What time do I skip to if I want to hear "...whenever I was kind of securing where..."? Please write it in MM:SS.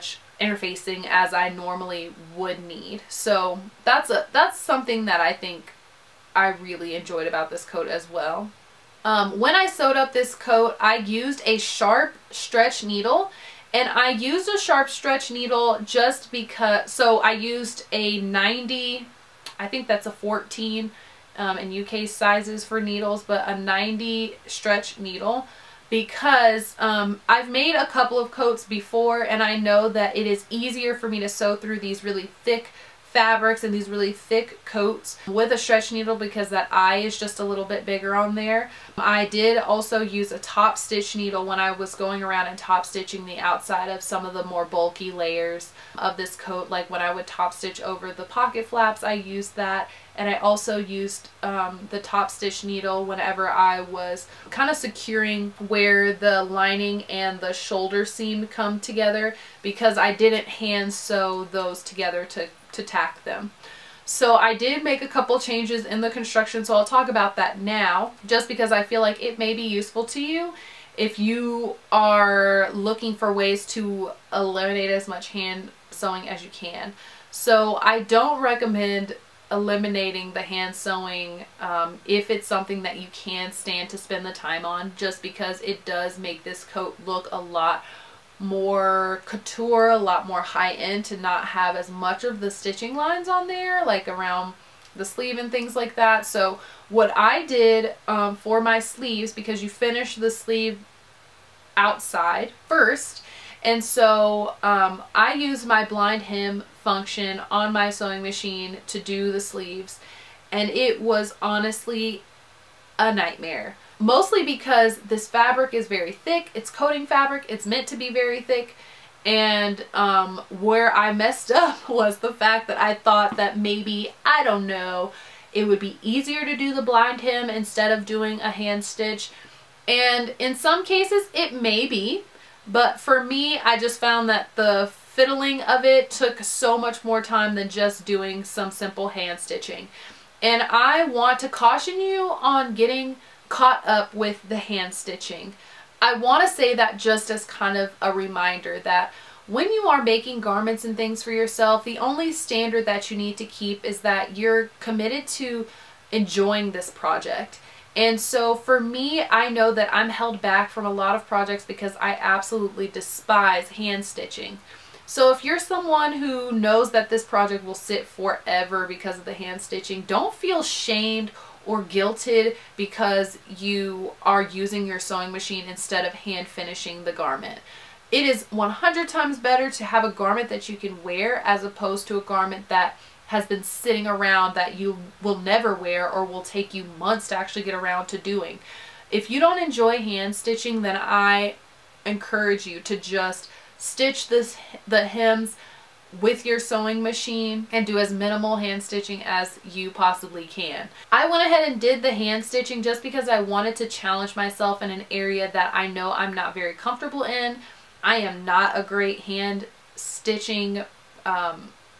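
00:53.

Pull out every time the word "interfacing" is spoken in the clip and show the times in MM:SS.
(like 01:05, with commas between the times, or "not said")
00:00.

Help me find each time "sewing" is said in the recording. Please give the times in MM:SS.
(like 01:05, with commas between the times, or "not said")
01:15, 01:20, 01:47, 02:54, 03:16.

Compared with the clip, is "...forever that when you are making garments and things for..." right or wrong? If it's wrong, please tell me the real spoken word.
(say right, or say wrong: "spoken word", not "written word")
wrong: "reminder", not "forever".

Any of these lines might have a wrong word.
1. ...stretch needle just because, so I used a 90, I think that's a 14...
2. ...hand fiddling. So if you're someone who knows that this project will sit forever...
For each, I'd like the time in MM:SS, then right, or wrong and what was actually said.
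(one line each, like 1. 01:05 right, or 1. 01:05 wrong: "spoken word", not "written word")
1. 00:14 right
2. 02:43 wrong: "stitching", not "fiddling".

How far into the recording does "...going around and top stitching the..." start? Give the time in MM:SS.
00:41.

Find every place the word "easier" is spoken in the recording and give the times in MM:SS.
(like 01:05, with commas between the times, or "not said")
00:30, 02:06.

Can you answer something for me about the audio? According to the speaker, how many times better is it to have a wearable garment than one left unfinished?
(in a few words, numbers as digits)
100.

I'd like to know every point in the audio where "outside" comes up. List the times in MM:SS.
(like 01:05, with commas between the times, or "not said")
00:43, 01:41.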